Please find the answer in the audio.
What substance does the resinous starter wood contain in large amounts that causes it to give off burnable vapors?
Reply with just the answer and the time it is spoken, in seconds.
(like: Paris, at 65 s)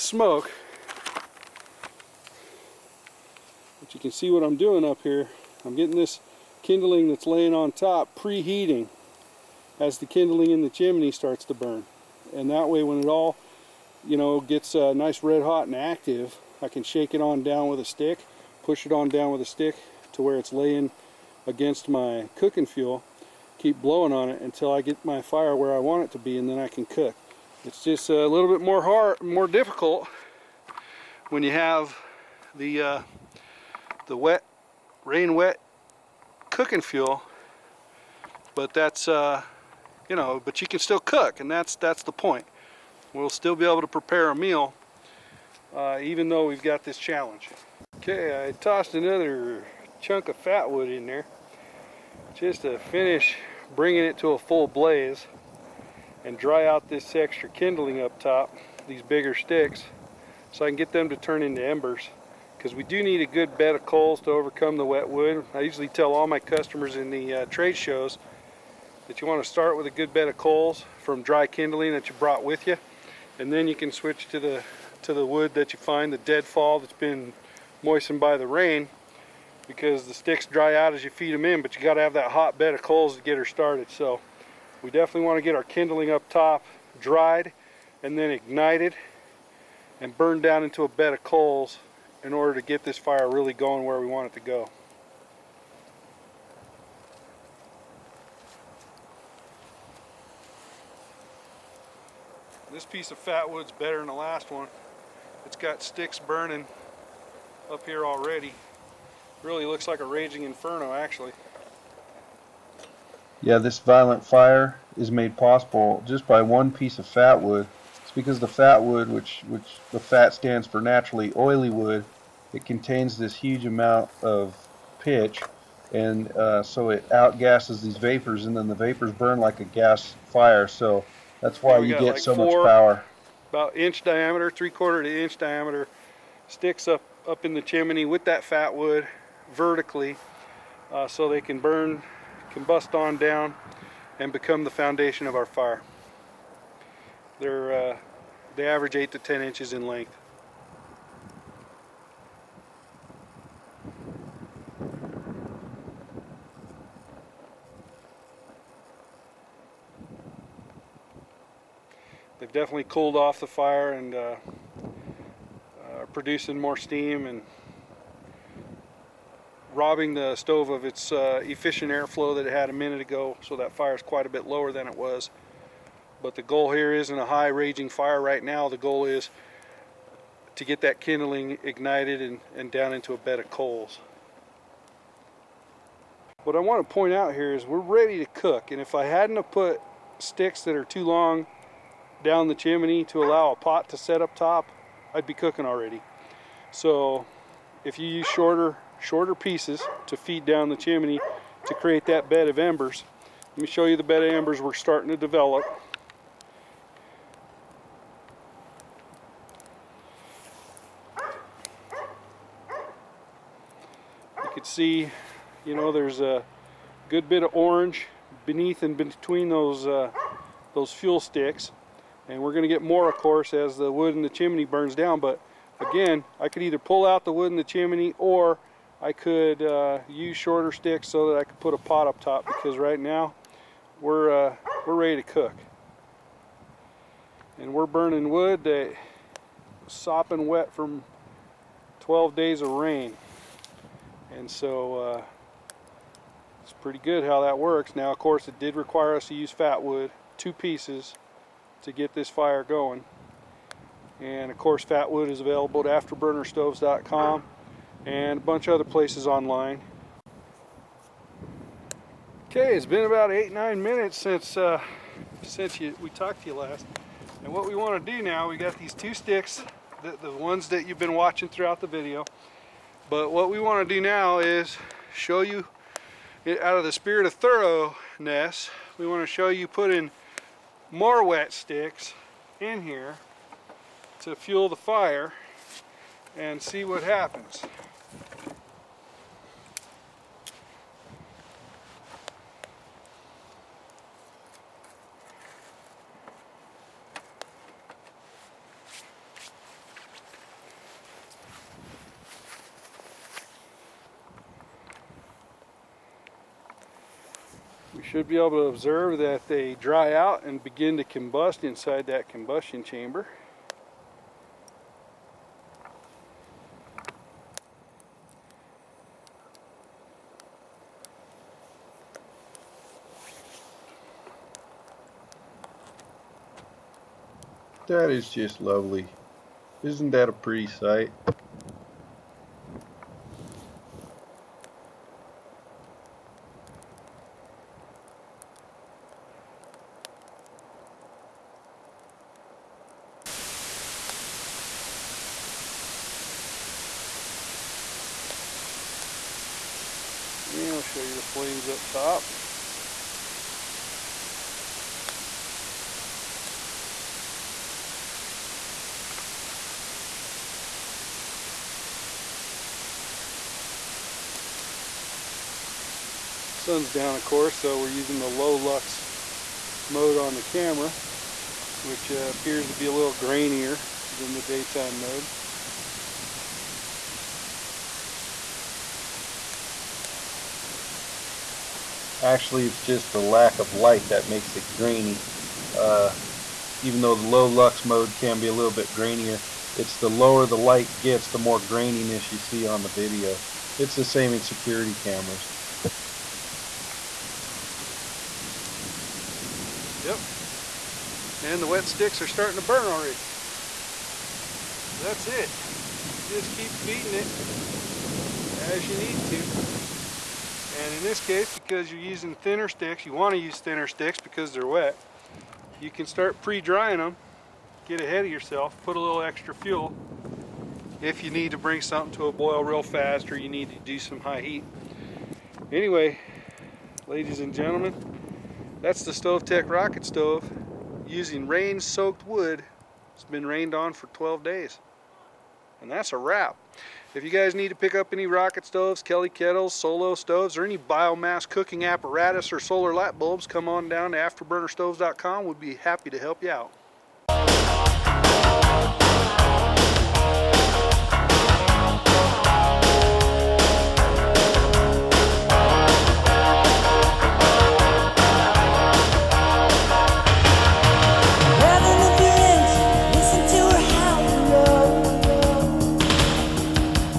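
pitch, at 124 s.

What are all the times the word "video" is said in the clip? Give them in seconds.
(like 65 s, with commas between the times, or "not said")
271 s, 392 s.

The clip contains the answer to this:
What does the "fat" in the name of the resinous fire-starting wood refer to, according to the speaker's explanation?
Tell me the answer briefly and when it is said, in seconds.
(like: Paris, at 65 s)
naturally oily wood, at 120 s.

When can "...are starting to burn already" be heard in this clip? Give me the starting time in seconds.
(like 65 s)
402 s.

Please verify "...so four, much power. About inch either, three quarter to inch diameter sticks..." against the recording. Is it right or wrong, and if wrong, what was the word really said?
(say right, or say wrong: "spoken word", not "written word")
wrong: "diameter", not "either".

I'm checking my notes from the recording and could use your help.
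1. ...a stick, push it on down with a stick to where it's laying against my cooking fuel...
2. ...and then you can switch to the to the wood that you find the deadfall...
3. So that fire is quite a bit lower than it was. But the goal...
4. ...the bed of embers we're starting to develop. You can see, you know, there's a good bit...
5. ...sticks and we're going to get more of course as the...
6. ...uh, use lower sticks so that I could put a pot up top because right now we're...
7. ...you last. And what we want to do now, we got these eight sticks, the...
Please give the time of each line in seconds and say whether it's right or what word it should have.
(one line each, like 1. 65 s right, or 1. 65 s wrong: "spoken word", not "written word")
1. 17 s right
2. 73 s right
3. 173 s right
4. 203 s right
5. 221 s right
6. 229 s wrong: "shorter", not "lower"
7. 266 s wrong: "two", not "eight".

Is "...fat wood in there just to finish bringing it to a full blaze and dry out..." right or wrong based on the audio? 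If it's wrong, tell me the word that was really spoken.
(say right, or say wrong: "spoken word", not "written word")
right.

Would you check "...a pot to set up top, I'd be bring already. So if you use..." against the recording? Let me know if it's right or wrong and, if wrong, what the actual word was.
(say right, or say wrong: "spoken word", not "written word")
wrong: "cooking", not "bring".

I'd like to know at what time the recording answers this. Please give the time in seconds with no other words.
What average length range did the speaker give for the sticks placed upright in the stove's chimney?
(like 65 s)
148 s.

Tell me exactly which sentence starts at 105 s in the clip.
It's got sticks burning up here already.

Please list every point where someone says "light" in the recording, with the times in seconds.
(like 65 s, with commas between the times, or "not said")
383 s, 390 s, 442 s.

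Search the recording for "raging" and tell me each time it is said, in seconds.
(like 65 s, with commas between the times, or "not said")
110 s, 177 s.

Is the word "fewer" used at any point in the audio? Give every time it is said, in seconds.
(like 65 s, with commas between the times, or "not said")
not said.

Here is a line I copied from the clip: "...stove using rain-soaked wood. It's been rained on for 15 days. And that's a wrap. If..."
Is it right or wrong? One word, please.
wrong.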